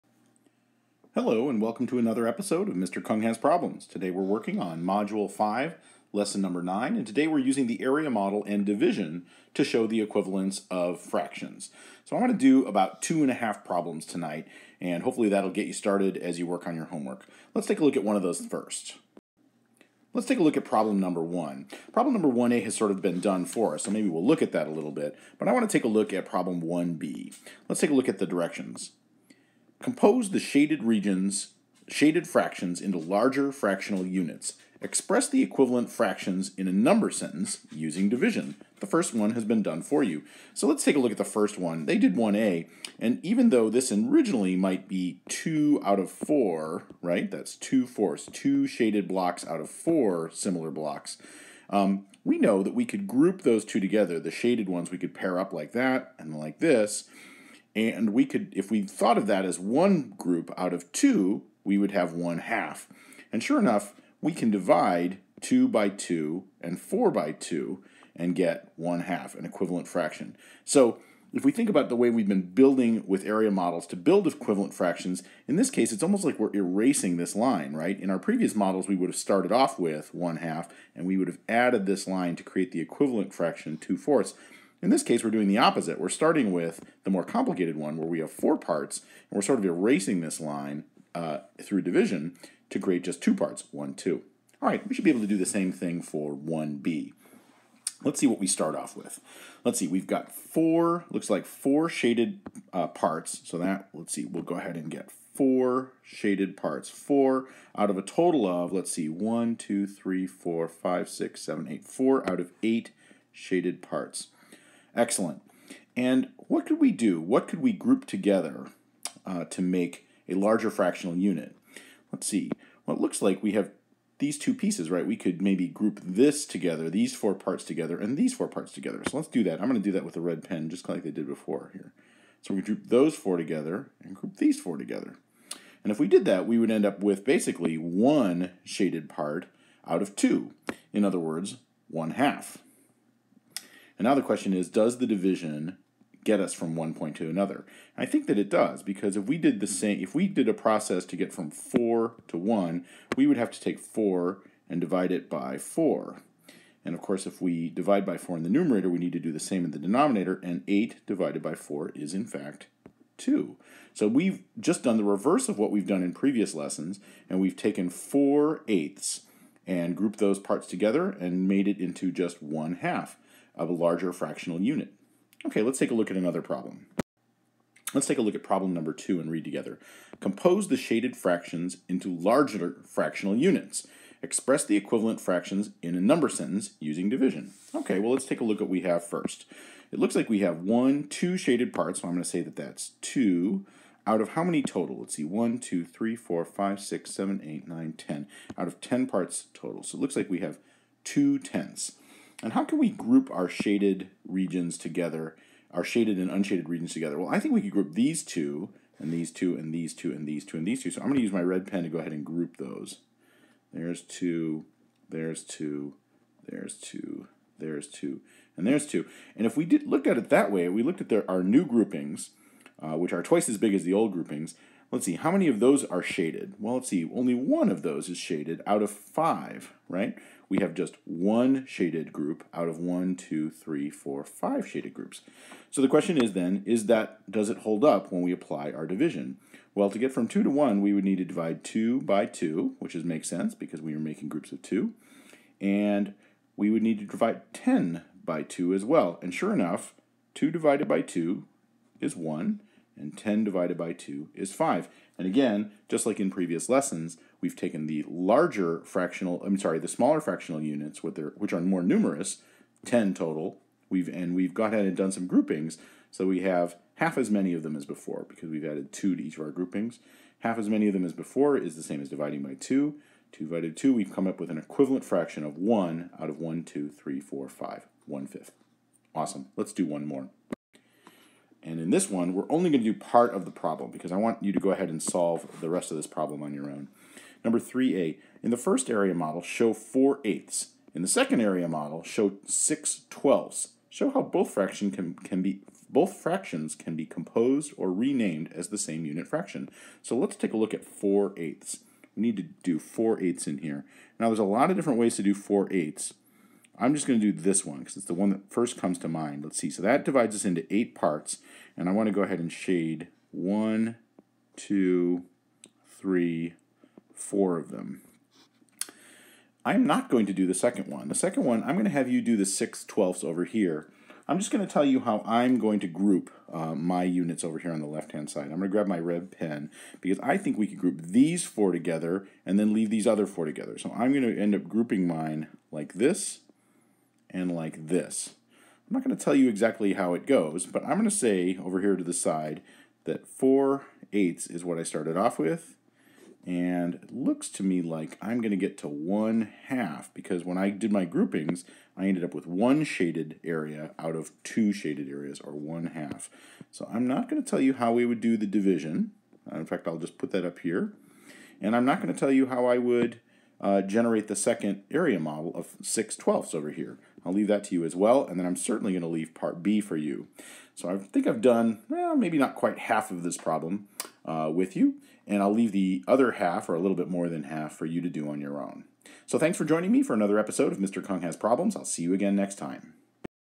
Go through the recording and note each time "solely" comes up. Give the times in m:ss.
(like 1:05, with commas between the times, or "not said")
not said.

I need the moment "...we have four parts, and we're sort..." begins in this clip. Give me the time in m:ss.
1:28.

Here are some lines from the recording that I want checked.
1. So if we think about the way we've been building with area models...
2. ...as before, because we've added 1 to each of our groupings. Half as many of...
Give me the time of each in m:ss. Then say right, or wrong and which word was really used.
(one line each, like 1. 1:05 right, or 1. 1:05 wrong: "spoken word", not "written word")
1. 1:10 right
2. 4:27 wrong: "2", not "1".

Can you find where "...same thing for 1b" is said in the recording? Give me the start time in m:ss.
1:35.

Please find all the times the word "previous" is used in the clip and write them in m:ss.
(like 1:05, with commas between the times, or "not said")
1:18, 2:46, 4:16.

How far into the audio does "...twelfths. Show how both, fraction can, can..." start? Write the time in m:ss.
4:53.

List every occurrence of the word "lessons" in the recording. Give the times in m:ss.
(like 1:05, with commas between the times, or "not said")
0:06, 2:46, 4:16.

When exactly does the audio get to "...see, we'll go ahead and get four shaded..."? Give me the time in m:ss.
1:44.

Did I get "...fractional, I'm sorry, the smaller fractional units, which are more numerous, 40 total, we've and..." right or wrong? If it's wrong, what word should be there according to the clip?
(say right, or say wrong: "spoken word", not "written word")
wrong: "10", not "40".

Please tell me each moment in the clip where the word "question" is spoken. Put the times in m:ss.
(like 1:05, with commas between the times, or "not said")
2:24, 3:55.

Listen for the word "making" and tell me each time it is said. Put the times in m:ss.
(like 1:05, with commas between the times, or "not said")
4:03.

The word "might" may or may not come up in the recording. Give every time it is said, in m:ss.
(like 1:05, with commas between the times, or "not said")
0:44.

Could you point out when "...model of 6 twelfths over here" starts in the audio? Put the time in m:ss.
6:05.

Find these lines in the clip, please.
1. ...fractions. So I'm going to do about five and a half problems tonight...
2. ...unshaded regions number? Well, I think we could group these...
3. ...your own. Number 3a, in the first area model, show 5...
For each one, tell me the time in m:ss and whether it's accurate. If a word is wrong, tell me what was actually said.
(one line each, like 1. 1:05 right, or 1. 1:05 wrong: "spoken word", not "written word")
1. 0:11 wrong: "two", not "five"
2. 3:26 wrong: "together", not "number"
3. 4:46 wrong: "4", not "5".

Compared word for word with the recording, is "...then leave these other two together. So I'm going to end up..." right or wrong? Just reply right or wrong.
wrong.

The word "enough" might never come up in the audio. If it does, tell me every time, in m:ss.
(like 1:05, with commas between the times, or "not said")
1:03, 4:09.